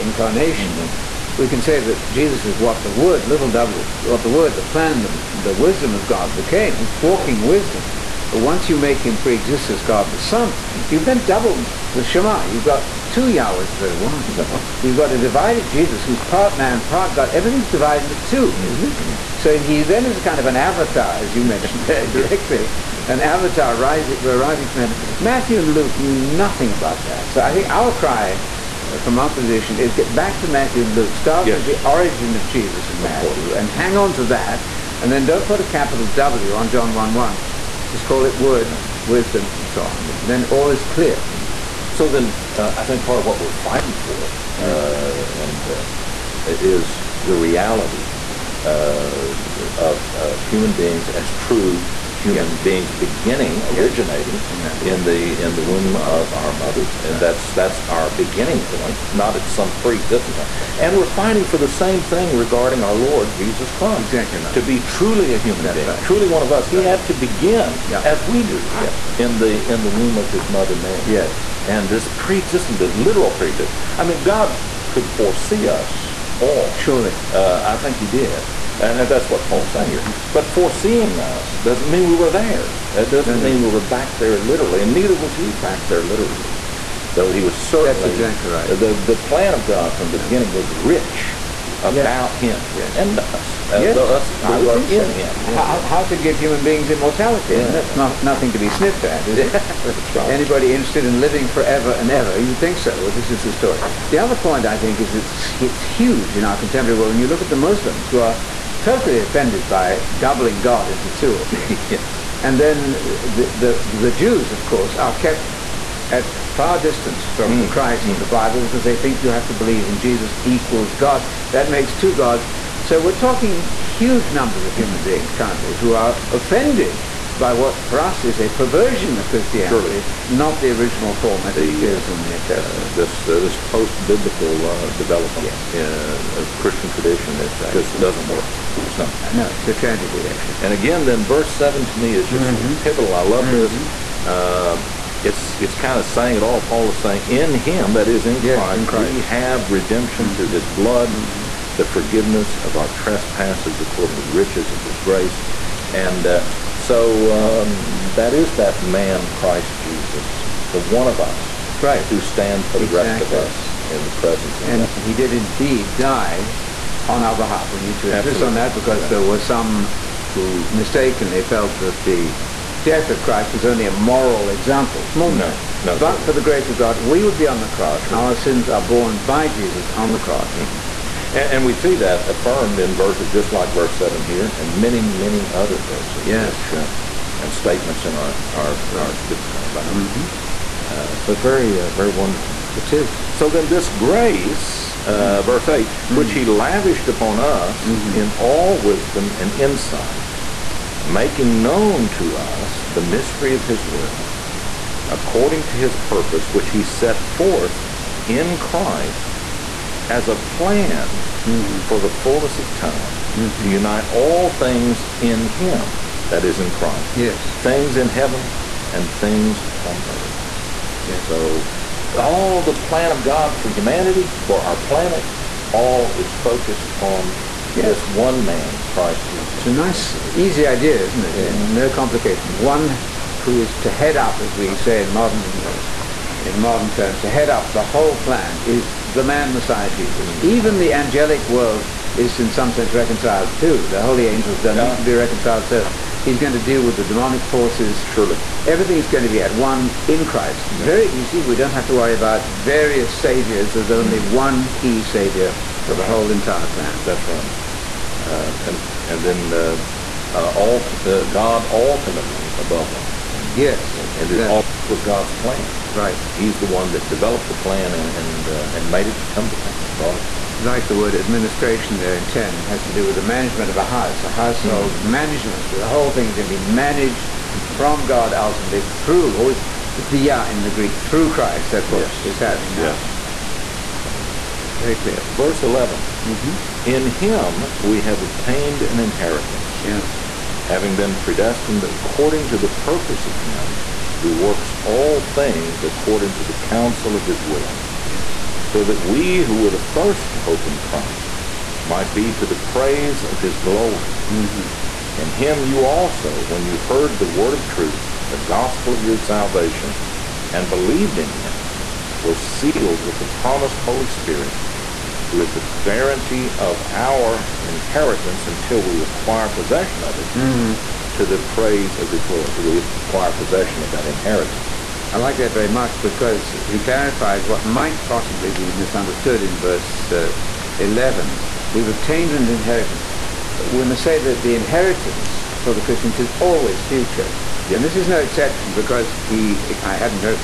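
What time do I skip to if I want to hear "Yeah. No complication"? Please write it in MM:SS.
03:51.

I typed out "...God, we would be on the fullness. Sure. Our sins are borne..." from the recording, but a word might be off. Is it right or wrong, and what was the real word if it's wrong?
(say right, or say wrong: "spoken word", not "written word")
wrong: "cross", not "fullness".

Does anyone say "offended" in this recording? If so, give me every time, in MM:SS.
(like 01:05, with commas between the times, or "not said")
01:49, 02:06.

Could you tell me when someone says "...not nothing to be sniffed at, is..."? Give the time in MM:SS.
01:37.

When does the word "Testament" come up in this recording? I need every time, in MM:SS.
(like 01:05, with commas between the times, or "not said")
02:12.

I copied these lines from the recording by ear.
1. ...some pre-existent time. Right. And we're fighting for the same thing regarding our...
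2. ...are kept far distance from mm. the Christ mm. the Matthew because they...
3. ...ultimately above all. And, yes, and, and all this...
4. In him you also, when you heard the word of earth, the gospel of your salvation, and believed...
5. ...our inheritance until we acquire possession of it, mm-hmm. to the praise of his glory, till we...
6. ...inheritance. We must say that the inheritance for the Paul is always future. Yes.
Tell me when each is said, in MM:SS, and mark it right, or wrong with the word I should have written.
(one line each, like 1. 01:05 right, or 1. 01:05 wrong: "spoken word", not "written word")
1. 00:59 right
2. 01:54 wrong: "Bible", not "Matthew"
3. 04:21 right
4. 05:05 wrong: "truth", not "earth"
5. 05:16 right
6. 05:32 wrong: "Christians", not "Paul".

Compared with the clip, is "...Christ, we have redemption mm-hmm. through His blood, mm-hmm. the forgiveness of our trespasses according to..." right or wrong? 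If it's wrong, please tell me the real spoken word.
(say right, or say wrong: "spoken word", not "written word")
right.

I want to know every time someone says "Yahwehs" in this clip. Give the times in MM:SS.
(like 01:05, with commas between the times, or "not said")
00:13.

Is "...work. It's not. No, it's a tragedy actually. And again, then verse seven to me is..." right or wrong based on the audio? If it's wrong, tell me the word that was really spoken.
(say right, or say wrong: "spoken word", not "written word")
right.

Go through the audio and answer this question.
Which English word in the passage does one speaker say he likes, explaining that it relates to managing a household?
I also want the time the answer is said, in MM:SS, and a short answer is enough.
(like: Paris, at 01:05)
administration, at 04:31.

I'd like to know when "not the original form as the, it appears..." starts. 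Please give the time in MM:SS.
02:10.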